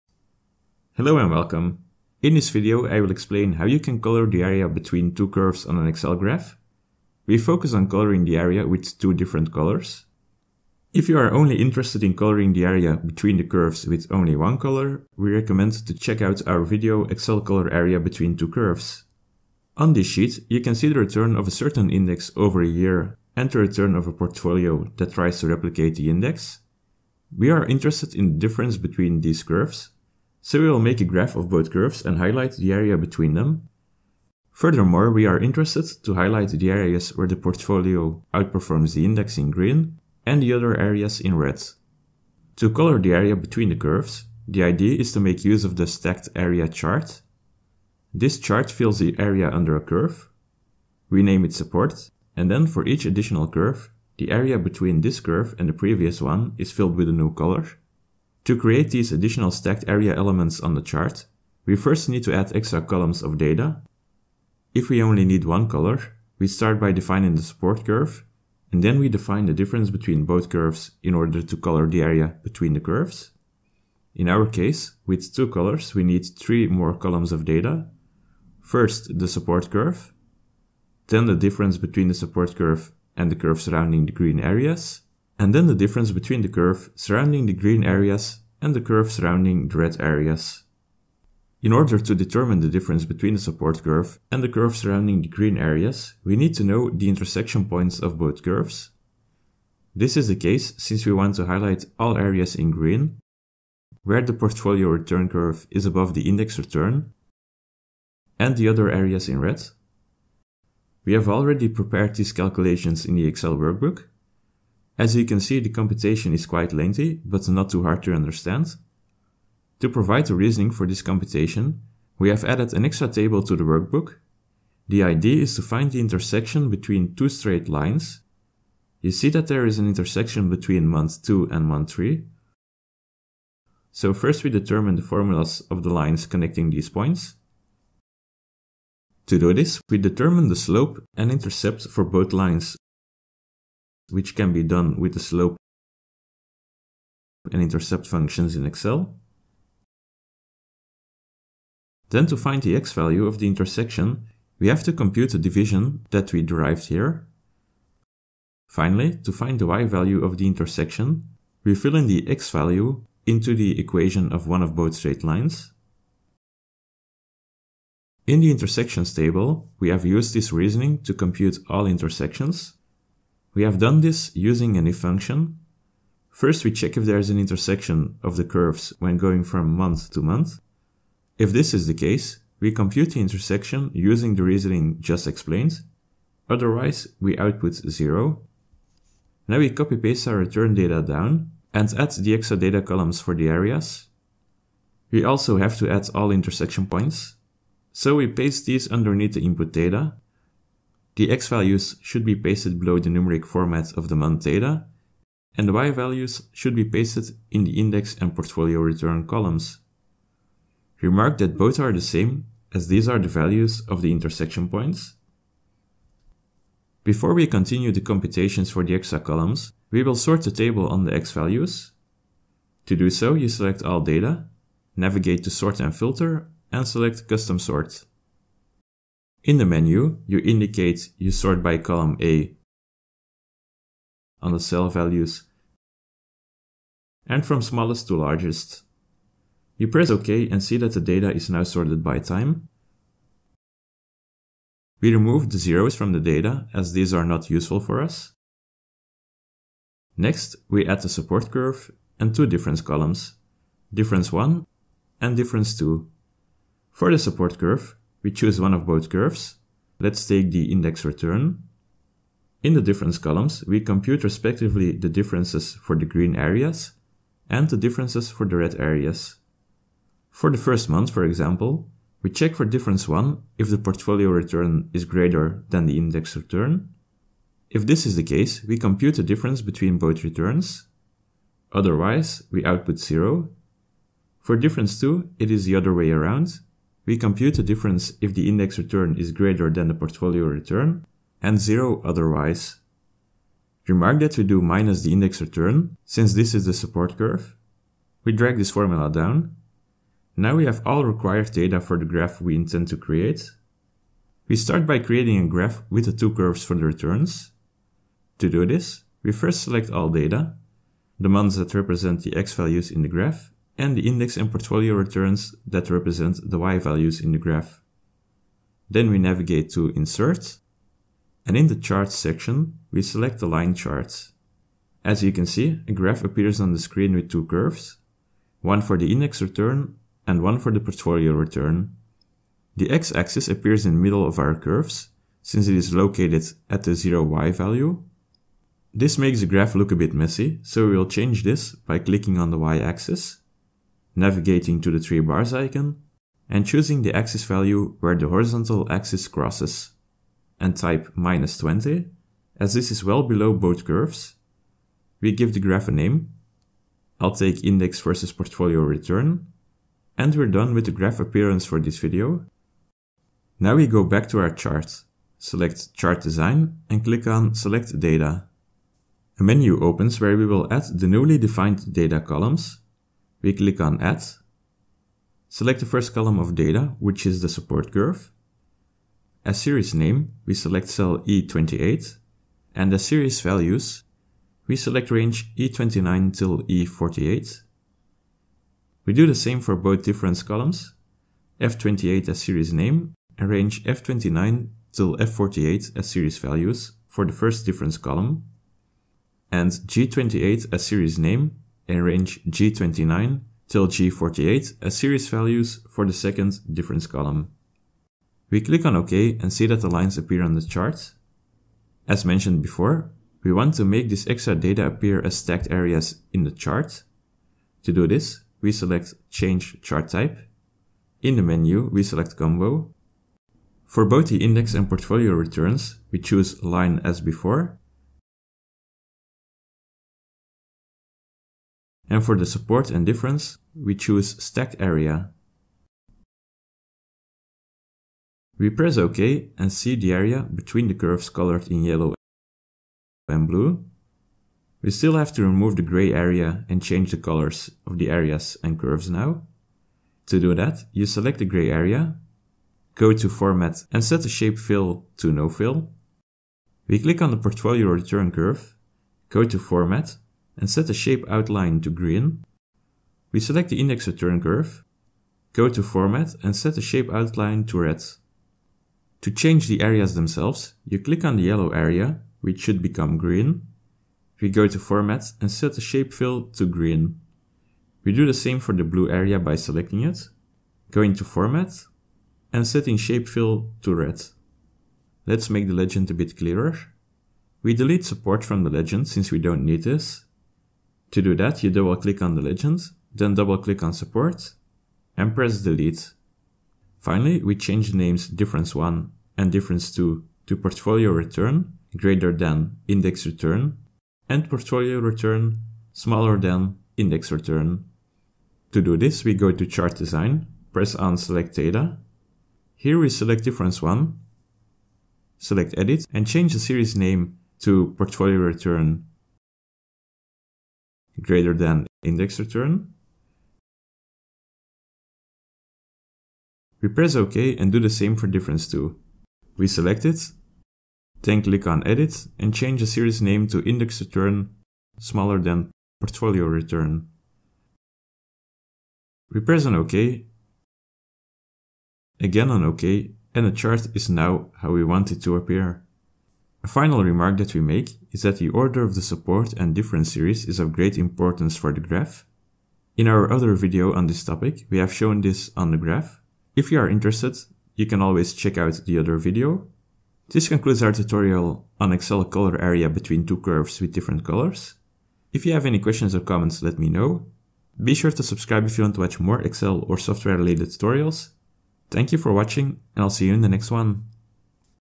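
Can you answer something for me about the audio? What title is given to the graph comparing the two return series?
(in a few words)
Index versus portfolio return.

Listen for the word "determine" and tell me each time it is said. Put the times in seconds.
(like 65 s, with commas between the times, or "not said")
92 s, 134 s, 139 s.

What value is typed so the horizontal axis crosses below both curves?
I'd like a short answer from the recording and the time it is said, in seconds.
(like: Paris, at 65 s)
-20, at 351 s.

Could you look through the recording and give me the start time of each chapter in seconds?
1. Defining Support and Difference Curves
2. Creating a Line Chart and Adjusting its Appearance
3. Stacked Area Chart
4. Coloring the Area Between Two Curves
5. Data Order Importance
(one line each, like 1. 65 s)
1. 117 s
2. 37 s
3. 193 s
4. 100 s
5. 242 s.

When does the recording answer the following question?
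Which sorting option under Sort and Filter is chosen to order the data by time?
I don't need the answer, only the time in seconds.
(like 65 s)
227 s.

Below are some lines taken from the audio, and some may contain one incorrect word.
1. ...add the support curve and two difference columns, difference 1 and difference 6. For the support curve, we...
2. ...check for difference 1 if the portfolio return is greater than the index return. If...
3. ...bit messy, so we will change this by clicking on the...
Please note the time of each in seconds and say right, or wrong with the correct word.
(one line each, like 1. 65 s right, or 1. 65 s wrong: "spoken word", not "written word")
1. 250 s wrong: "2", not "6"
2. 272 s right
3. 339 s right.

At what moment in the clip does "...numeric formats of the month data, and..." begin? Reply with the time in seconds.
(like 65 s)
203 s.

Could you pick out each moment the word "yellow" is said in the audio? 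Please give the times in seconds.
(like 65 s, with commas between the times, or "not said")
441 s, 471 s.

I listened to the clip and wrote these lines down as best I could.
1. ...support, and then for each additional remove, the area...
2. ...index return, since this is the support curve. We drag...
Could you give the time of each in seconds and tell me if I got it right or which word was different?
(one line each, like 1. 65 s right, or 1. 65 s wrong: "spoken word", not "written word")
1. 51 s wrong: "curve", not "remove"
2. 295 s right.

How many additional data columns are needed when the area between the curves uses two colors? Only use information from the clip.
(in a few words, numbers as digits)
3.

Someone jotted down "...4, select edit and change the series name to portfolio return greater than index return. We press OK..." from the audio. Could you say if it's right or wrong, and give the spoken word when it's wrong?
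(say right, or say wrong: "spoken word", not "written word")
wrong: "1", not "4".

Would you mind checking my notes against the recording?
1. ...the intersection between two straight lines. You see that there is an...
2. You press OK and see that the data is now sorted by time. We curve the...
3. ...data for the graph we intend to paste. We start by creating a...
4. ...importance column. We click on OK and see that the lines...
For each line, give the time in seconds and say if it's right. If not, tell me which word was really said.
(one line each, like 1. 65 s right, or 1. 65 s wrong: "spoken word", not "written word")
1. 125 s right
2. 239 s wrong: "remove", not "curve"
3. 301 s wrong: "create", not "paste"
4. 406 s wrong: "difference", not "importance".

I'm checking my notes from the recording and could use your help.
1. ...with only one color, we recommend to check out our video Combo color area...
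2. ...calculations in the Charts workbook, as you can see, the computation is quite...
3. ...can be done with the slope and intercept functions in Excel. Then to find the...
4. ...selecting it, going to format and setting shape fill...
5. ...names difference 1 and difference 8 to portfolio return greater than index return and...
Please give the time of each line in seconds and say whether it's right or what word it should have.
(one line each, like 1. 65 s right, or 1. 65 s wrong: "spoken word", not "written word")
1. 13 s wrong: "Excel", not "Combo"
2. 112 s wrong: "Excel", not "Charts"
3. 144 s right
4. 479 s right
5. 497 s wrong: "2", not "8".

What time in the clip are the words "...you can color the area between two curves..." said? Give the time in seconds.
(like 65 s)
3 s.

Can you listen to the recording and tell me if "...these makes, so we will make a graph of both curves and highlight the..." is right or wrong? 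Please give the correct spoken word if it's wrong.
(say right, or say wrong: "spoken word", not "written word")
wrong: "curves", not "makes".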